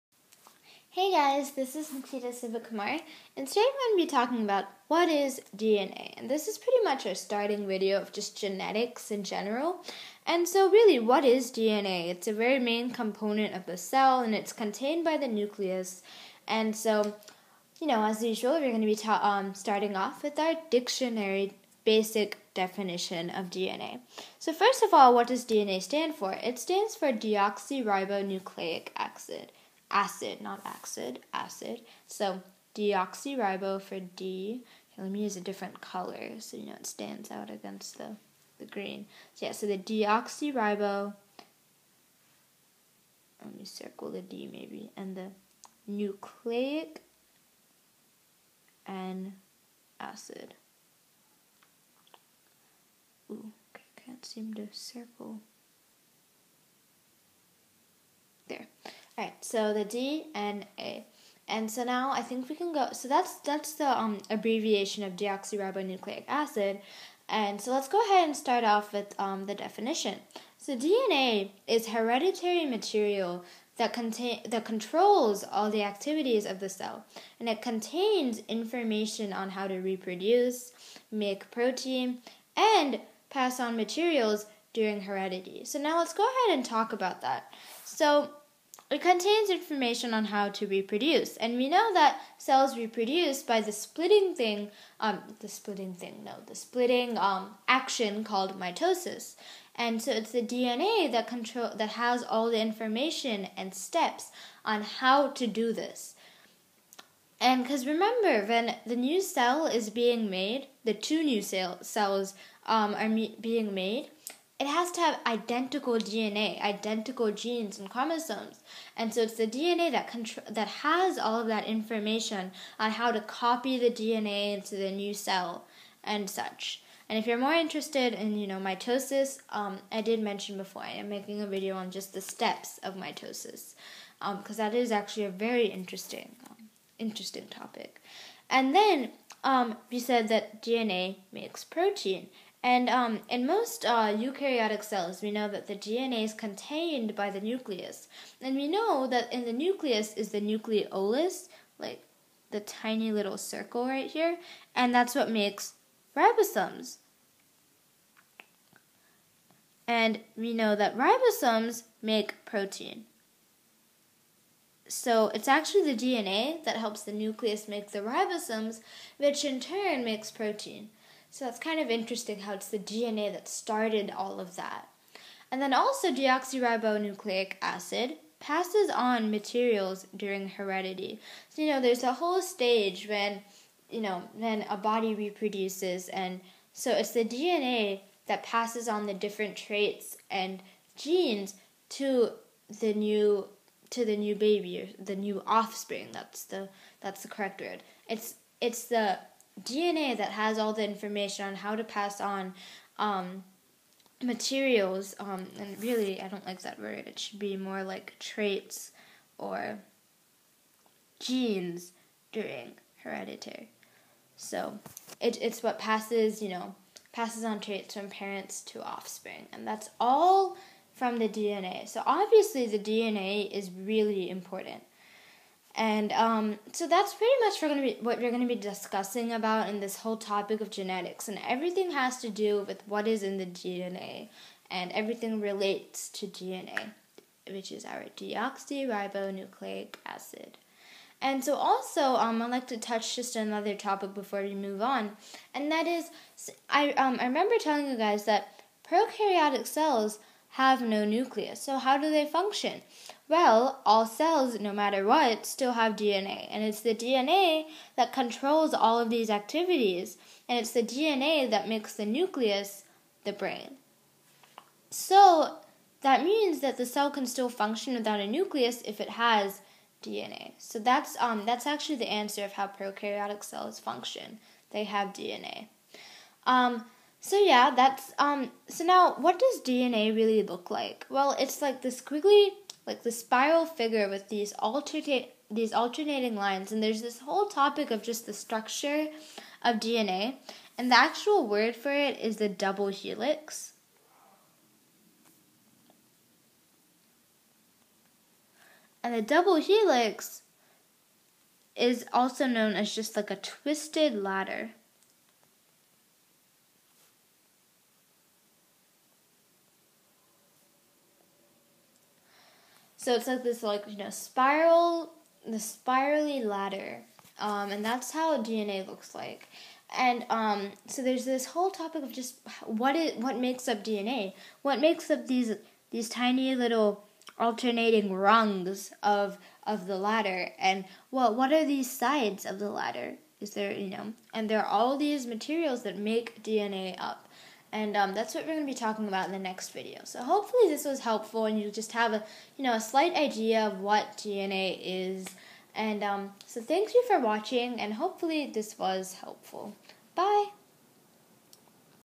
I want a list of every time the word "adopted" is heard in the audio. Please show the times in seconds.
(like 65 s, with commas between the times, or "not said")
not said.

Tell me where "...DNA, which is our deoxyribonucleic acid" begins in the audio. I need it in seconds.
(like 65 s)
236 s.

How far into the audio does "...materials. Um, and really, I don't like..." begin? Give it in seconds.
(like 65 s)
204 s.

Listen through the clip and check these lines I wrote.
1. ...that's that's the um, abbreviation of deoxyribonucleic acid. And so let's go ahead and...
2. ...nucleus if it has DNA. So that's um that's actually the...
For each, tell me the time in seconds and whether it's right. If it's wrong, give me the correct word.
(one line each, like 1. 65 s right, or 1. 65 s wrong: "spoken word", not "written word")
1. 63 s right
2. 268 s right.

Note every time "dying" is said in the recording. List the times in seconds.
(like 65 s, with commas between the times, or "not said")
not said.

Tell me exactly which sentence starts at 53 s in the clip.
Ooh, okay, can't seem to circle.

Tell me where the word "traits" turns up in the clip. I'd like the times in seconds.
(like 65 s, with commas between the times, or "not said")
189 s, 208 s, 217 s.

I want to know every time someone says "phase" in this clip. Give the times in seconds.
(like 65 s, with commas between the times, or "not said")
not said.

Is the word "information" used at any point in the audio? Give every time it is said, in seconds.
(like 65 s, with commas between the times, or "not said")
78 s, 89 s, 102 s, 121 s, 200 s.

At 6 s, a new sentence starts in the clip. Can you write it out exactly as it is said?
And this is pretty much our starting video of just genetics in general.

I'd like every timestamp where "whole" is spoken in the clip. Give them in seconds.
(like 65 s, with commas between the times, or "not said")
182 s, 229 s, 287 s, 321 s.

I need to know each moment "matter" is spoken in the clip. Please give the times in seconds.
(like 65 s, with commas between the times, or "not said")
254 s.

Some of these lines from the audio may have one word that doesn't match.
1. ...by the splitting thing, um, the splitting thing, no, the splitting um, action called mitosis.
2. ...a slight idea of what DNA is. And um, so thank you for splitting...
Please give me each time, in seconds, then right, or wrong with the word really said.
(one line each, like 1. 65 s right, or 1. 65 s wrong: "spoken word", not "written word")
1. 93 s right
2. 342 s wrong: "watching", not "splitting".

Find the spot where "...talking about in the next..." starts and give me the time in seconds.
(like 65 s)
338 s.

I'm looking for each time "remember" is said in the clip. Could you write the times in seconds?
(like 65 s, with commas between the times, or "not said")
107 s, 247 s.